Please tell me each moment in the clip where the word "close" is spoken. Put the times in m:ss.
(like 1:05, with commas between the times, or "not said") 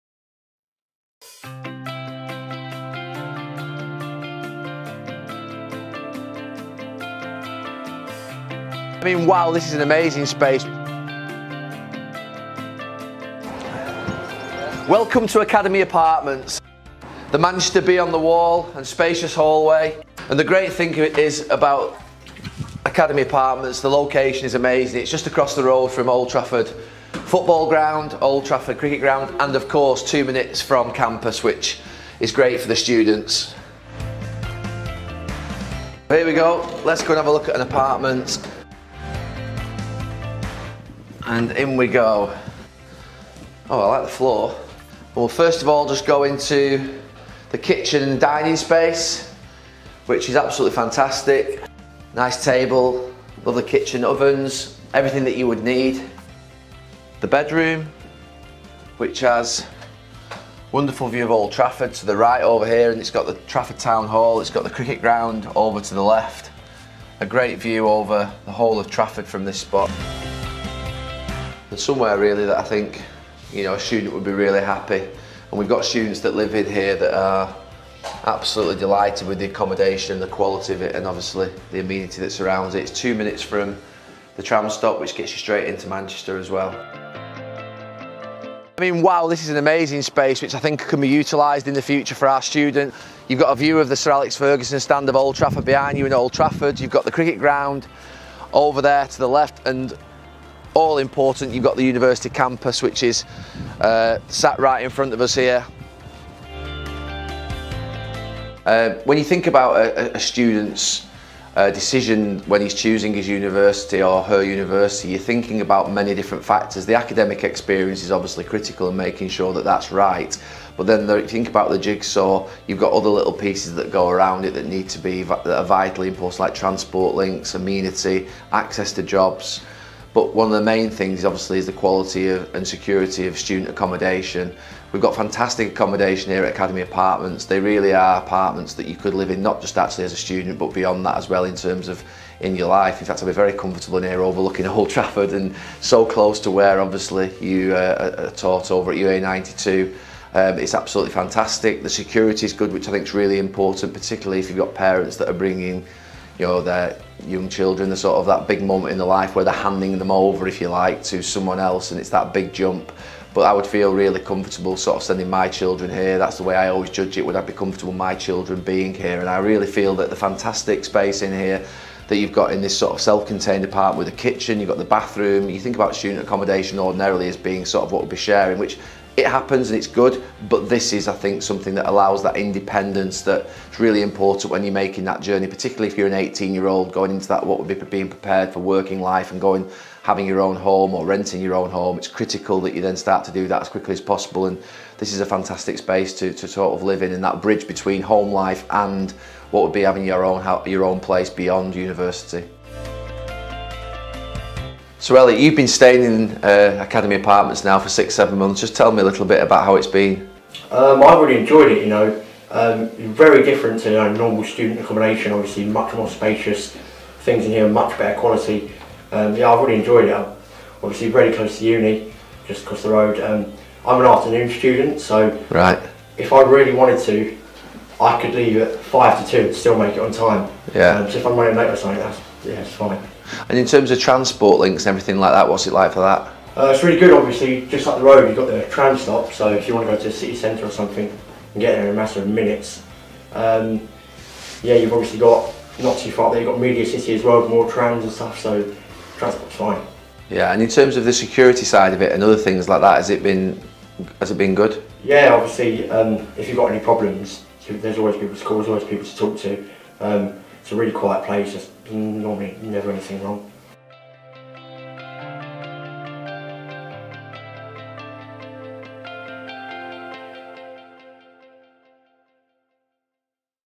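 2:26, 3:41.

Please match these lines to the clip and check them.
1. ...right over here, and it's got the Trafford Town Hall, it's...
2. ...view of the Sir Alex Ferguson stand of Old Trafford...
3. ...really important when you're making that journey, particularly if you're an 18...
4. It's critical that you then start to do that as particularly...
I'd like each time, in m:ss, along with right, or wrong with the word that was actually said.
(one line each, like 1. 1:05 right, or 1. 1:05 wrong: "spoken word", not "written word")
1. 1:02 right
2. 1:33 right
3. 3:03 right
4. 3:11 wrong: "quickly", not "particularly".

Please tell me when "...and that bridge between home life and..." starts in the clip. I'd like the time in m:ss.
3:17.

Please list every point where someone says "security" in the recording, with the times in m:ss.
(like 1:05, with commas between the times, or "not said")
2:12, 2:31, 4:11.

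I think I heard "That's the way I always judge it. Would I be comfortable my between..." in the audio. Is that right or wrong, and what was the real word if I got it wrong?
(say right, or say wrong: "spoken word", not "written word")
wrong: "children", not "between".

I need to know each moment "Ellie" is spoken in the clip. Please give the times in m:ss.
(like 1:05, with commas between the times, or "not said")
3:25.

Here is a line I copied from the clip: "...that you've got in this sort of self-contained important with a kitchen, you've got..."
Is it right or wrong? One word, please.
wrong.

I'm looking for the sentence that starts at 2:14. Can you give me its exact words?
We've got fantastic accommodation here at Academy Apartments.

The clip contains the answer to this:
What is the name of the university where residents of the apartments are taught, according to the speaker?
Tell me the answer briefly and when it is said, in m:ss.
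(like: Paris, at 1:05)
UA92, at 2:28.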